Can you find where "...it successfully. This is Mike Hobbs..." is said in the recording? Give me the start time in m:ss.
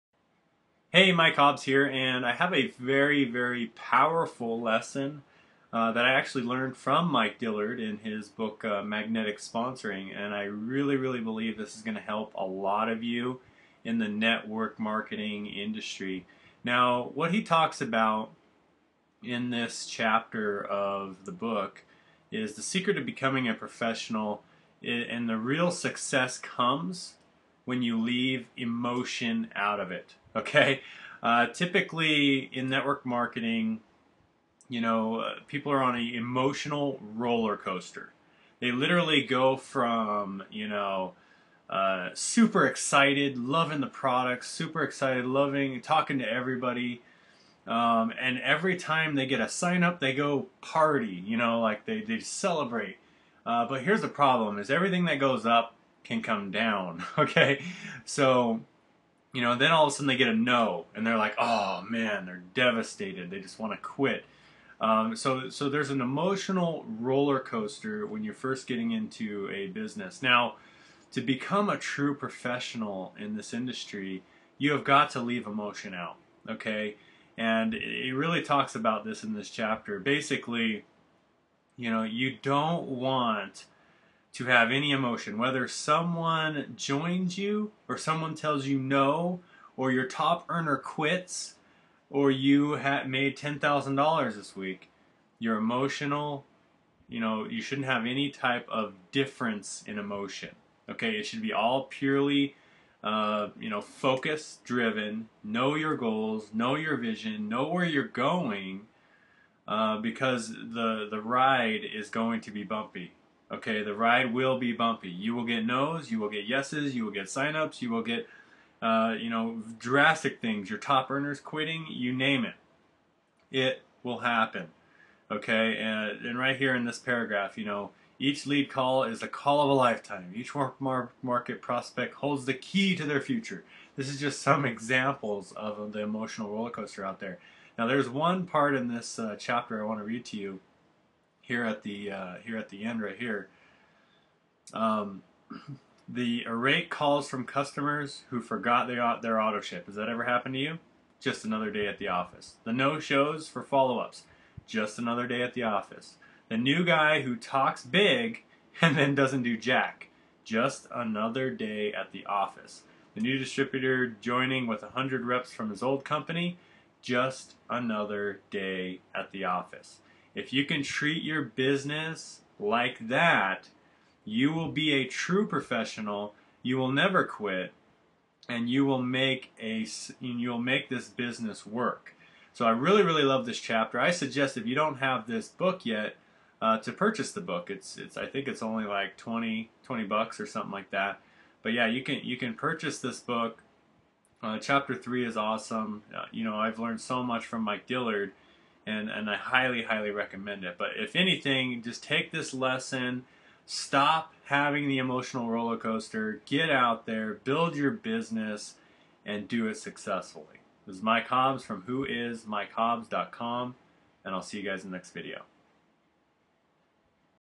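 3:29.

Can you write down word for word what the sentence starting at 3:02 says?
So I really really love this chapter.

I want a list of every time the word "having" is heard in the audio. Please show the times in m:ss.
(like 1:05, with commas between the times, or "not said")
3:24.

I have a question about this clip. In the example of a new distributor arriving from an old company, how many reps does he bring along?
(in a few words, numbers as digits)
100.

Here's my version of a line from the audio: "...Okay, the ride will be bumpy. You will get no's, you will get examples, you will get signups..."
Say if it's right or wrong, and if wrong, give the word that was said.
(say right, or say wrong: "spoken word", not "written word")
wrong: "yeses", not "examples".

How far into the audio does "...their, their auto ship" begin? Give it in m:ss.
2:28.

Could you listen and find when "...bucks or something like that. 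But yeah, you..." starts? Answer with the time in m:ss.
3:10.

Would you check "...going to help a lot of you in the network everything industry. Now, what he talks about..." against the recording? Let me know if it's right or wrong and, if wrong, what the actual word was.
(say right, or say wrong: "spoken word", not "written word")
wrong: "marketing", not "everything".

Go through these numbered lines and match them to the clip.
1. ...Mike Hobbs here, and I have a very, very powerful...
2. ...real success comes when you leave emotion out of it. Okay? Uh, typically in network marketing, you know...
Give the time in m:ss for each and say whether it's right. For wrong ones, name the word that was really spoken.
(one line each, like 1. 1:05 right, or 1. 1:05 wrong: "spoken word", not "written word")
1. 0:01 right
2. 0:25 right.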